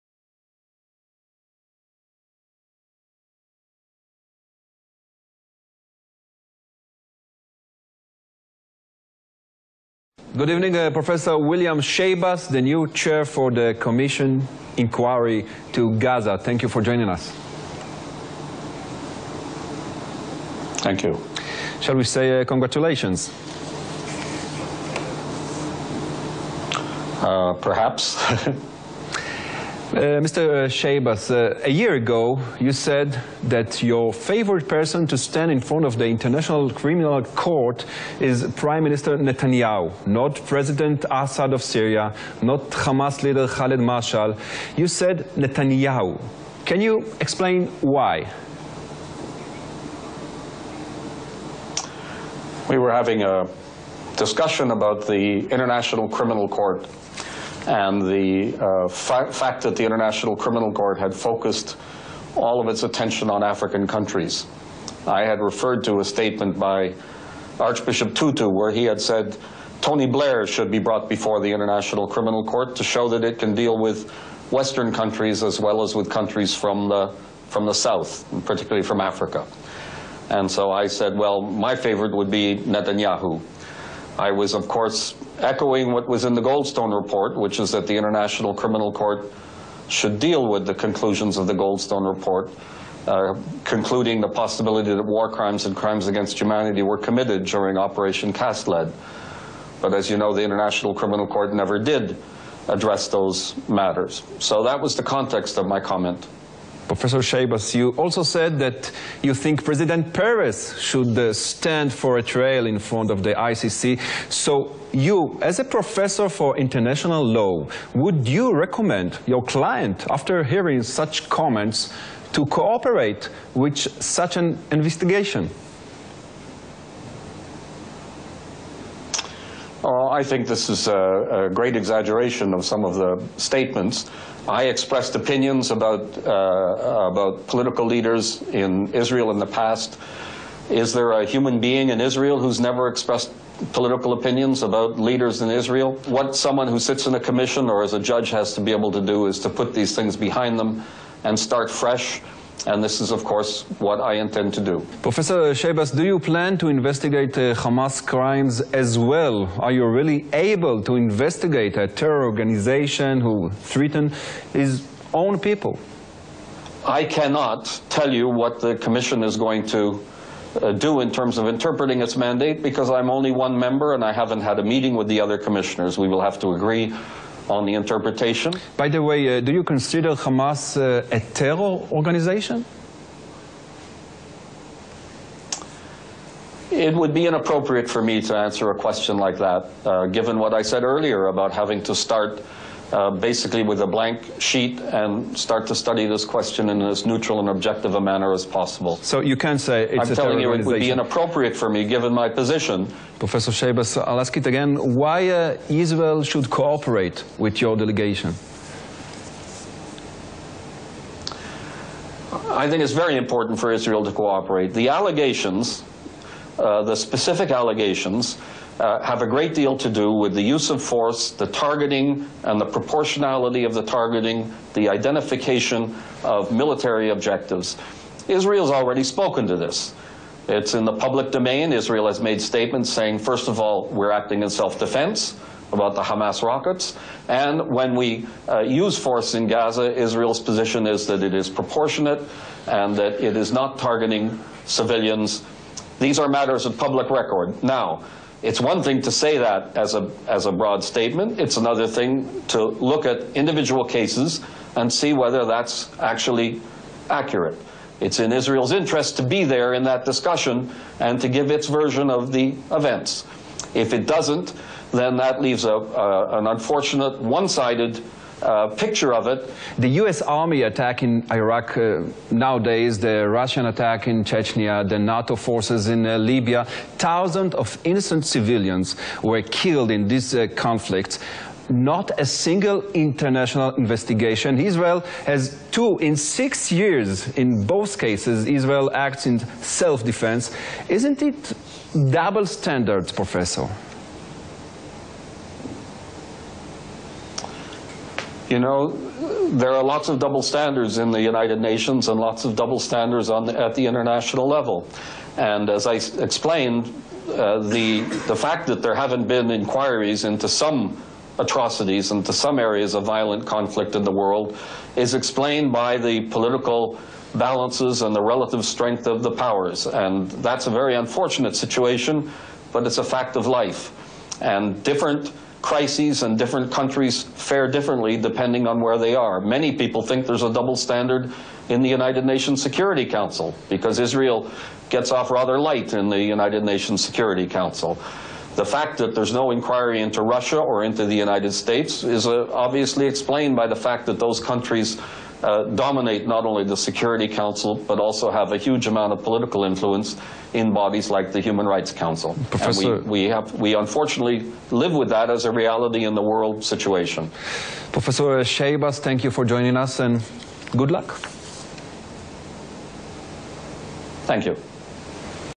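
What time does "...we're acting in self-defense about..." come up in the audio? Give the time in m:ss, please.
3:53.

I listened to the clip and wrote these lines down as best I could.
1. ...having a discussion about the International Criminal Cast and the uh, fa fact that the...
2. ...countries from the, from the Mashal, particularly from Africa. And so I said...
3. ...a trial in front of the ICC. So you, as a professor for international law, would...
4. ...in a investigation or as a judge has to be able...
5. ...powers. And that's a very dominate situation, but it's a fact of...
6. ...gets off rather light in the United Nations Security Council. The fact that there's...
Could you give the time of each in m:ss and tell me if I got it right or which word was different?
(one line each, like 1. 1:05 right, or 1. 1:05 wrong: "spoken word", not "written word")
1. 0:52 wrong: "Court", not "Cast"
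2. 1:16 wrong: "South", not "Mashal"
3. 1:52 right
4. 2:27 wrong: "commission", not "investigation"
5. 5:19 wrong: "unfortunate", not "dominate"
6. 5:34 right.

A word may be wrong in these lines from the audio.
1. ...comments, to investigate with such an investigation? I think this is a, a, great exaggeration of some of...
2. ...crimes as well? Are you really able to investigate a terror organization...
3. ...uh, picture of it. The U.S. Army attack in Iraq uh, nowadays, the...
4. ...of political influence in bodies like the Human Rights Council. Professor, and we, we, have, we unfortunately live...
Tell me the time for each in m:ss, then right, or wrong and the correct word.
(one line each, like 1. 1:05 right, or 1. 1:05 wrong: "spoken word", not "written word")
1. 2:01 wrong: "cooperate", not "investigate"
2. 2:38 right
3. 4:28 right
4. 5:49 right.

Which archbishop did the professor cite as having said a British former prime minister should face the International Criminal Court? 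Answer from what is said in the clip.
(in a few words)
Archbishop Tutu.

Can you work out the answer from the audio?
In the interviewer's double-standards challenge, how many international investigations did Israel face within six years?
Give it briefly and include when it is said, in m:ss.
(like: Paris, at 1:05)
2, at 4:45.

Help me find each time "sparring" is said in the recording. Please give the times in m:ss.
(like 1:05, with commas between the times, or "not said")
not said.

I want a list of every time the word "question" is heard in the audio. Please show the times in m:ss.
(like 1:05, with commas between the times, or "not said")
3:08, 3:16.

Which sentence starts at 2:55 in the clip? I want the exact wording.
We will have to agree on the interpretation.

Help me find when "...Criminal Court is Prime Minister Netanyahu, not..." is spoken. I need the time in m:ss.
0:36.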